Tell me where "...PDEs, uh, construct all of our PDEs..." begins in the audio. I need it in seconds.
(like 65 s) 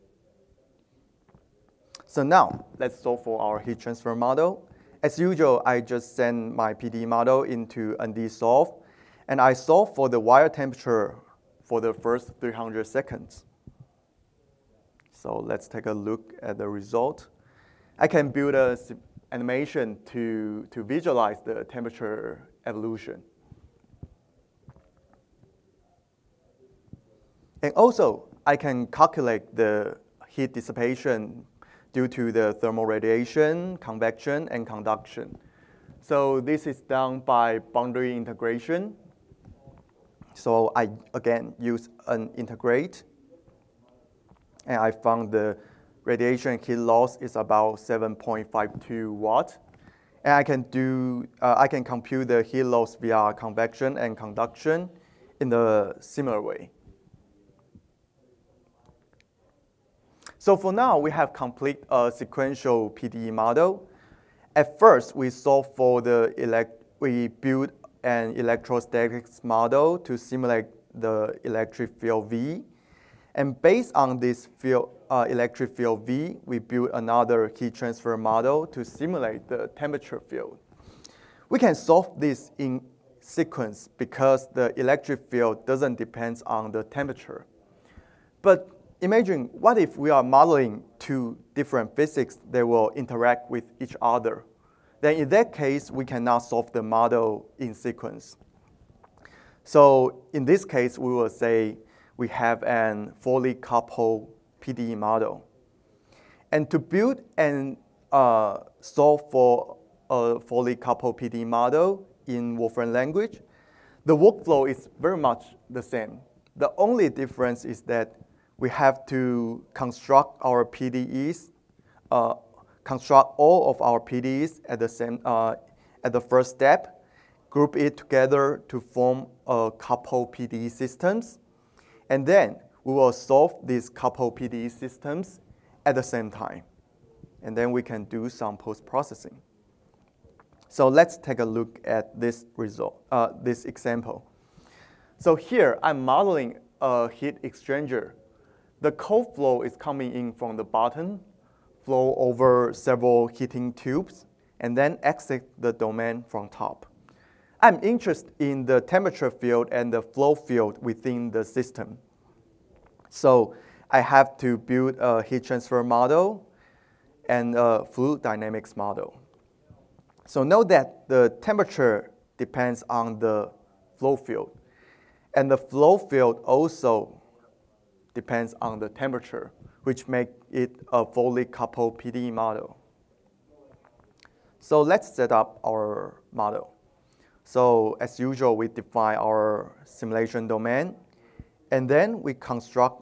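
120 s.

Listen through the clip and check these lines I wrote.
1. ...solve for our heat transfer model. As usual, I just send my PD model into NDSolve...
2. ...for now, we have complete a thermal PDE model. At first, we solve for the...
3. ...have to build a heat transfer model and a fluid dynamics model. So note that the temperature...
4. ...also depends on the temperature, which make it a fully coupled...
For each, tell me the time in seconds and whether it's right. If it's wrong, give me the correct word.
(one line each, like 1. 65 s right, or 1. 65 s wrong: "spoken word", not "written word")
1. 2 s right
2. 60 s wrong: "sequential", not "thermal"
3. 163 s right
4. 176 s right.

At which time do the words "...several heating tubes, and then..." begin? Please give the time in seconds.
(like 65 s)
152 s.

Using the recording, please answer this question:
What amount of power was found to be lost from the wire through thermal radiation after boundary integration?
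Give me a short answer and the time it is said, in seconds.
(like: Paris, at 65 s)
7.52 watts, at 47 s.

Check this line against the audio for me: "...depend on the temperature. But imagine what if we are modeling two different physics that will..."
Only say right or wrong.
right.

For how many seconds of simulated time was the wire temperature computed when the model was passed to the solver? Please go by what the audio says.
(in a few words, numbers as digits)
300 seconds.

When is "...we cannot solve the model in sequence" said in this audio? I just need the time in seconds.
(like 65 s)
95 s.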